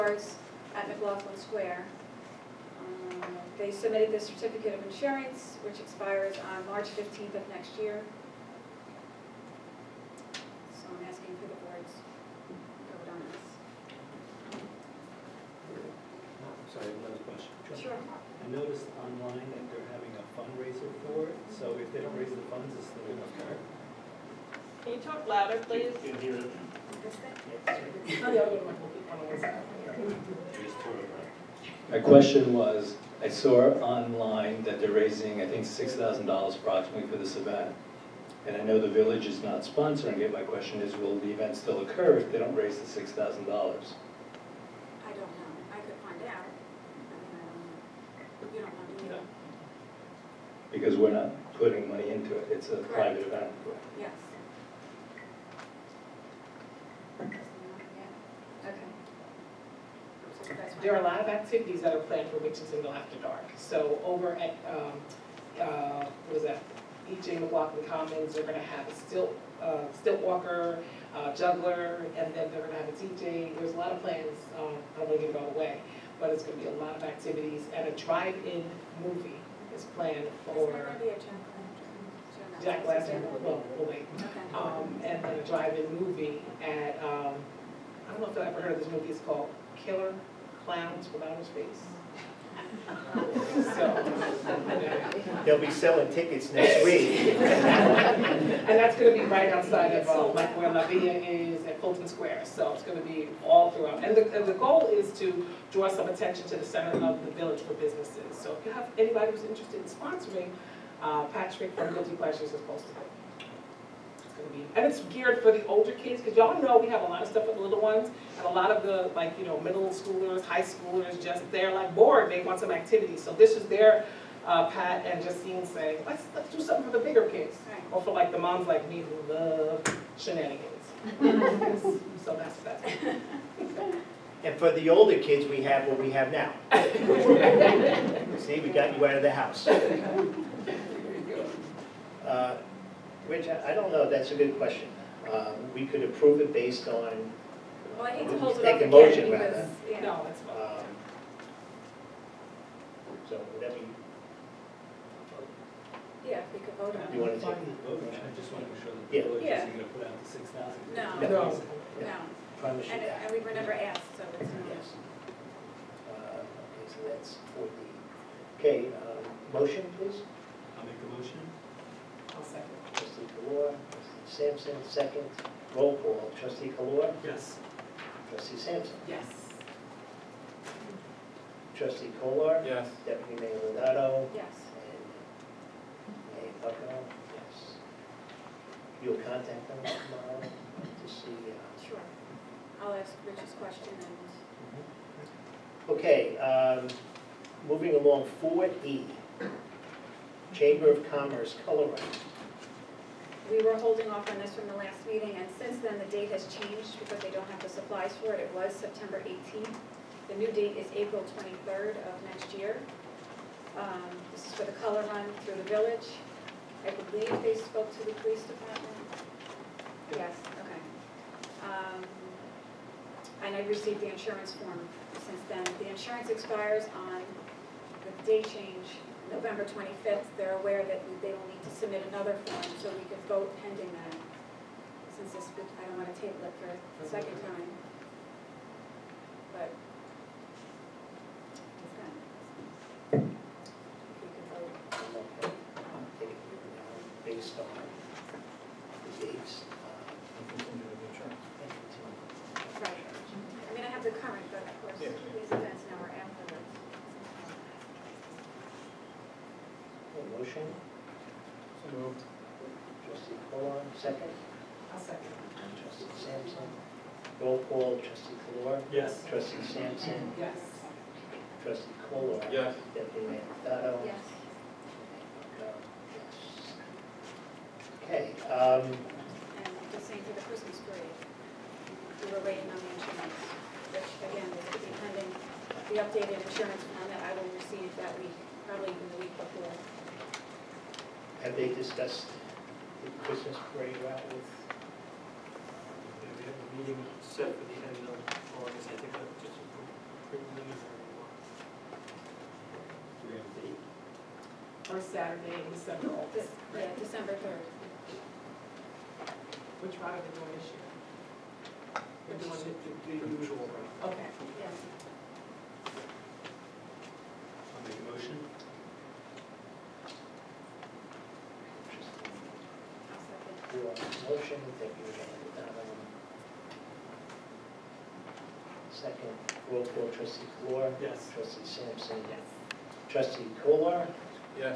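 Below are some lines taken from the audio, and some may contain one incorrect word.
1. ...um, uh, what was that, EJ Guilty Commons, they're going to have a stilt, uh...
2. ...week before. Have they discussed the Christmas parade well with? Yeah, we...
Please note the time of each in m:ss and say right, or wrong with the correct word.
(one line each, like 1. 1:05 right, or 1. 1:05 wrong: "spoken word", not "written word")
1. 1:04 wrong: "McLaughlin", not "Guilty"
2. 4:49 right.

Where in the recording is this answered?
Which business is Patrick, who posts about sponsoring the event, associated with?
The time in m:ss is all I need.
1:51.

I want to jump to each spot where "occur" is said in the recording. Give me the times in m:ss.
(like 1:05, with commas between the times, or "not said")
0:23, 0:41.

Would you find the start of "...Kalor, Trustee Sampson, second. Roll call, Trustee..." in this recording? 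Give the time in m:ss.
2:53.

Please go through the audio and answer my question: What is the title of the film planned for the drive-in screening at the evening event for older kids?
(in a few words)
Killer Clowns from Outer Space.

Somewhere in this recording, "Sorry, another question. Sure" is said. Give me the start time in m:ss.
0:16.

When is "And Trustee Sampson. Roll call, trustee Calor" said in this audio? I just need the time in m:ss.
4:25.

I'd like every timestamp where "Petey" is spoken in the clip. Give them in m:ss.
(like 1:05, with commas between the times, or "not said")
not said.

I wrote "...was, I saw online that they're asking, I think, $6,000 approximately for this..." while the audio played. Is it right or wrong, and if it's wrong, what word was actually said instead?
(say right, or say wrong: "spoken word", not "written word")
wrong: "raising", not "asking".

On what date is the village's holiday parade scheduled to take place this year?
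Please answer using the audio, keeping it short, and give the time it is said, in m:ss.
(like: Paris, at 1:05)
December 3, at 5:06.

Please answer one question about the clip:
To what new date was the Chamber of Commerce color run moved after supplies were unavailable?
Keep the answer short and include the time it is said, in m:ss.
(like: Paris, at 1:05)
April 23, at 3:30.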